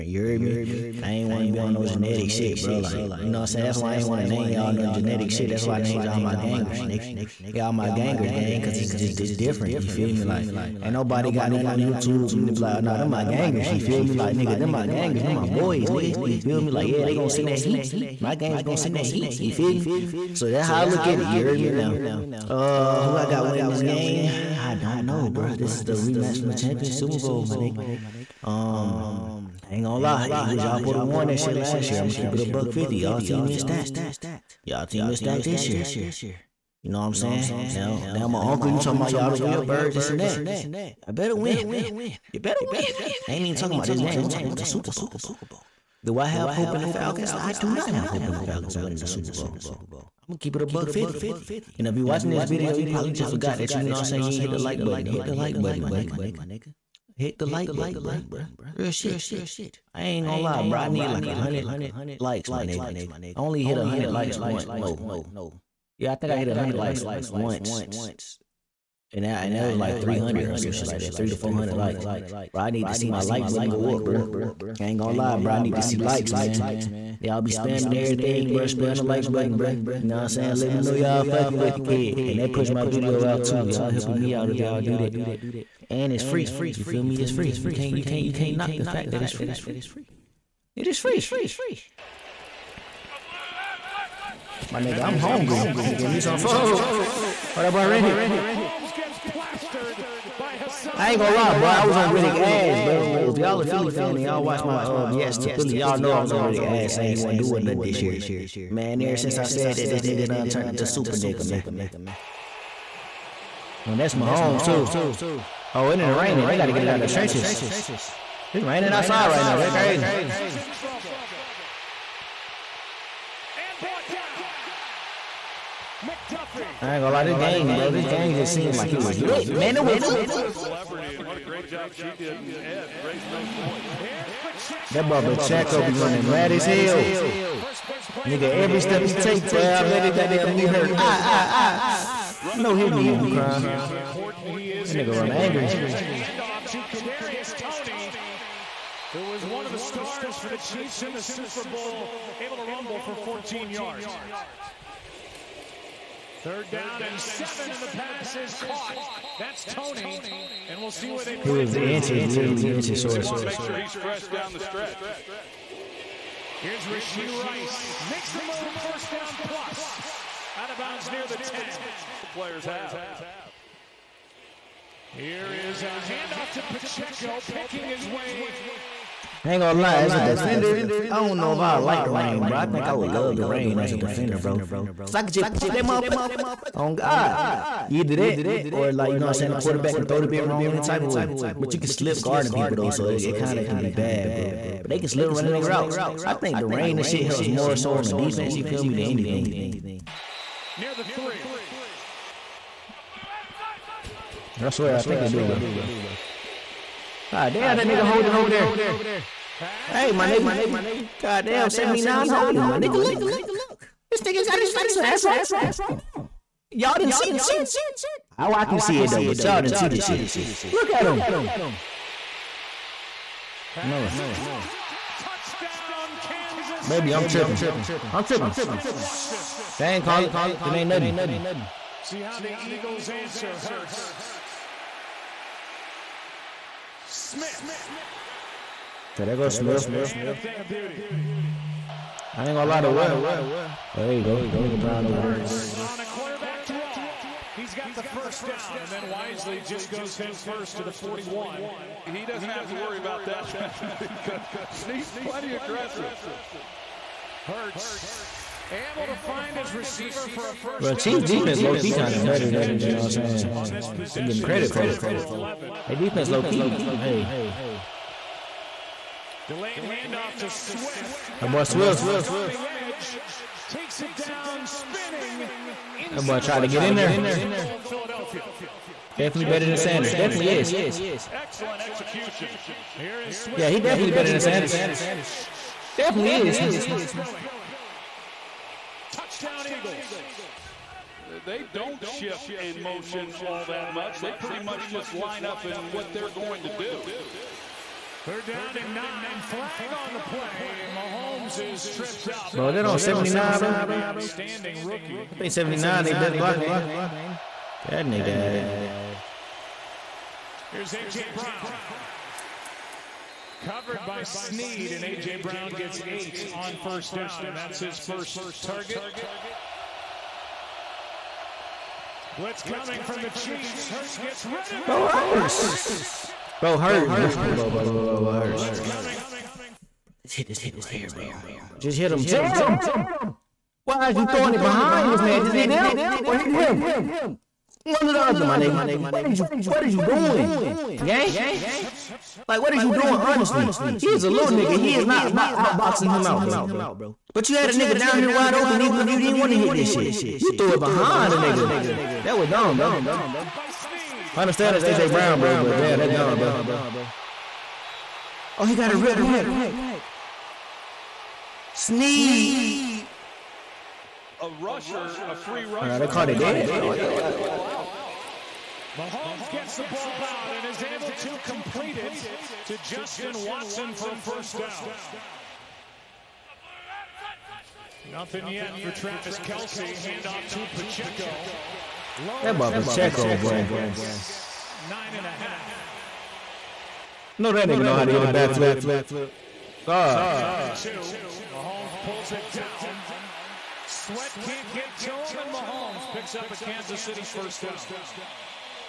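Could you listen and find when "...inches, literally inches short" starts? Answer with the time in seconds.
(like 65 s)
161 s.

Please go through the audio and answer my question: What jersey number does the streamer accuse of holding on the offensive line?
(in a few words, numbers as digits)
79.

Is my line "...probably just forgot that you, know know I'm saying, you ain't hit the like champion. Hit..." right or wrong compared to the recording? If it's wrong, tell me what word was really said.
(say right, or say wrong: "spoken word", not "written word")
wrong: "button", not "champion".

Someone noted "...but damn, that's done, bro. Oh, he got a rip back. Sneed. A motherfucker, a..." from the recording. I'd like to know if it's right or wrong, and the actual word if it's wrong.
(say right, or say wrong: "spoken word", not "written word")
wrong: "rusher", not "motherfucker".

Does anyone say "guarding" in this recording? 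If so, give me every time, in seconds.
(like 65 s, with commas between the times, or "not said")
192 s.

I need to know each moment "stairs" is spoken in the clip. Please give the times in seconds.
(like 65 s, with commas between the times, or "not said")
not said.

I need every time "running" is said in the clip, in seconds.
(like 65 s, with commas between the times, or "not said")
135 s, 195 s.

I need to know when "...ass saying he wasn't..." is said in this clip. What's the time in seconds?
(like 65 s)
106 s.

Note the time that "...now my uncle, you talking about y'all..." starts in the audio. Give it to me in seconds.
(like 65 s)
38 s.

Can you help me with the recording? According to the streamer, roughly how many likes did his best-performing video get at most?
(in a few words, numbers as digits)
400.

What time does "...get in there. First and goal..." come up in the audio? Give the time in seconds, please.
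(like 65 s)
276 s.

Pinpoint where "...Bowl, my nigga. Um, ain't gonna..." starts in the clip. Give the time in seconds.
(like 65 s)
27 s.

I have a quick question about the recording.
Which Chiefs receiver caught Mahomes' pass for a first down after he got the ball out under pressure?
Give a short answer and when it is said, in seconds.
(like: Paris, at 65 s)
Justin Watson, at 372 s.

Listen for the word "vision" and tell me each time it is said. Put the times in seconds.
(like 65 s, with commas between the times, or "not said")
not said.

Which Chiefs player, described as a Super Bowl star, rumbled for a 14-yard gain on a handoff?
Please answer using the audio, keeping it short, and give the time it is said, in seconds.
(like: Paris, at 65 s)
Kadarius Toney, at 146 s.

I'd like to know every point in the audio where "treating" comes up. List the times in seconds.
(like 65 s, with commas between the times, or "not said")
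not said.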